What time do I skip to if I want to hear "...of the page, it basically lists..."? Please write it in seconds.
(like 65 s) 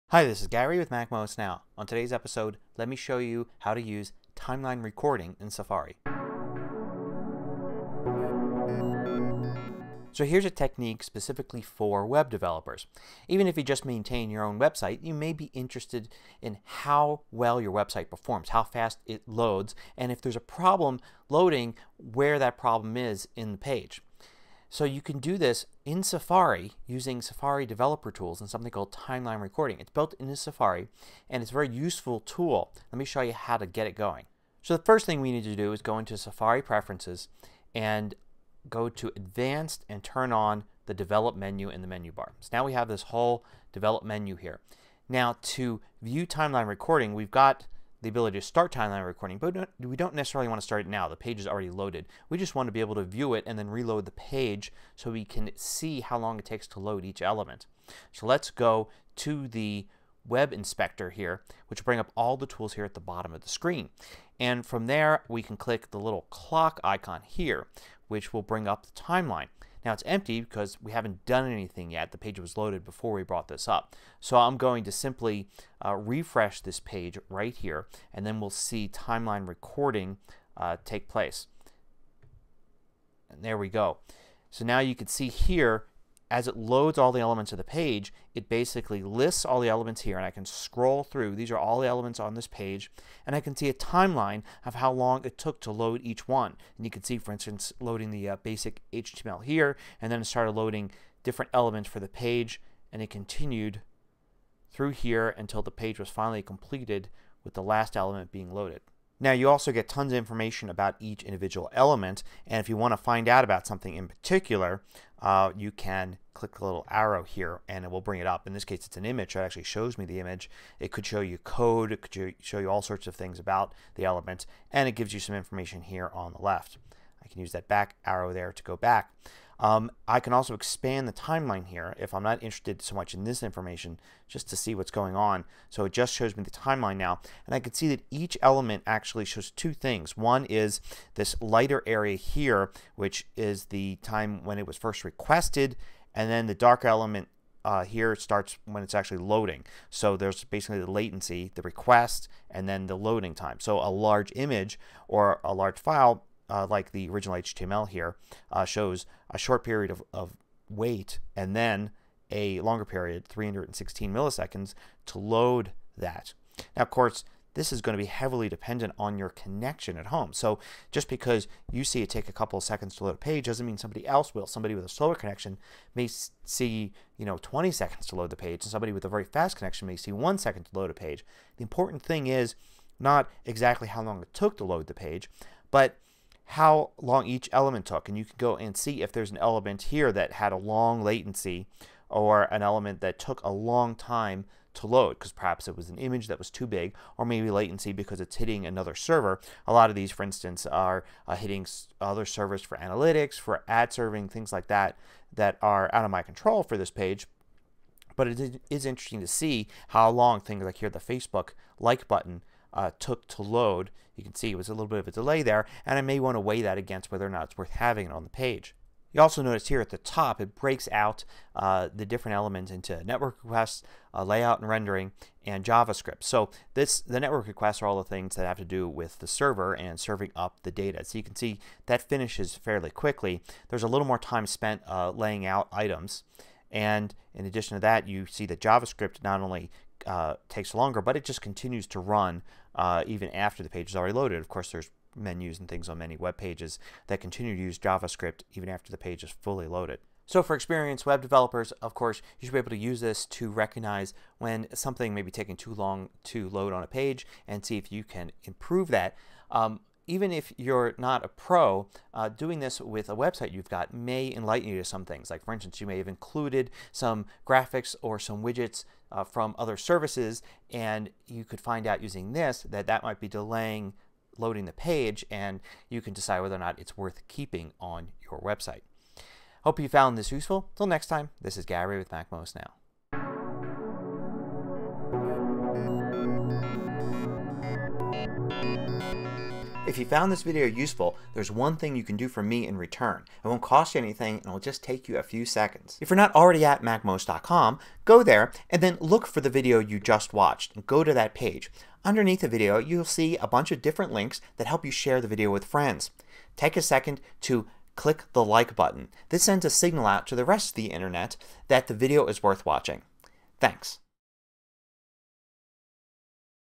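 87 s.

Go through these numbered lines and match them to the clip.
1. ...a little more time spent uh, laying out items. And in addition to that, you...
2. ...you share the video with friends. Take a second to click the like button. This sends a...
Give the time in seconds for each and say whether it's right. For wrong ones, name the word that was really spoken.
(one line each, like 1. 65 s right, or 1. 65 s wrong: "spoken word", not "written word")
1. 233 s right
2. 304 s right.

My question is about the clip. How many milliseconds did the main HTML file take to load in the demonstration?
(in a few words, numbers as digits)
316.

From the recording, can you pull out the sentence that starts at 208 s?
But it is interesting to see how long things like here, the Facebook like button uh, took to load.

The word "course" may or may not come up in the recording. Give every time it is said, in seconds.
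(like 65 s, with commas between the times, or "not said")
166 s, 244 s, 251 s.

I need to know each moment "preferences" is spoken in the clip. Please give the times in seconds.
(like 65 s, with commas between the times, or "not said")
36 s.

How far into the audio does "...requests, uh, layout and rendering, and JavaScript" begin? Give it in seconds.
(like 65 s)
223 s.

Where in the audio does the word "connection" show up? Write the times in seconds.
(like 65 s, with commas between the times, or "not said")
169 s, 175 s, 179 s.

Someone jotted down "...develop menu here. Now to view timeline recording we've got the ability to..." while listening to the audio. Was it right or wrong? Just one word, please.
right.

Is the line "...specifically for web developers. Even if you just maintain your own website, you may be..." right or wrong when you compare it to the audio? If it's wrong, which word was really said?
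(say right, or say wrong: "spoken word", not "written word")
right.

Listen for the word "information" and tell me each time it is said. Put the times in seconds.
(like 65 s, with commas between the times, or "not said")
110 s, 125 s, 133 s.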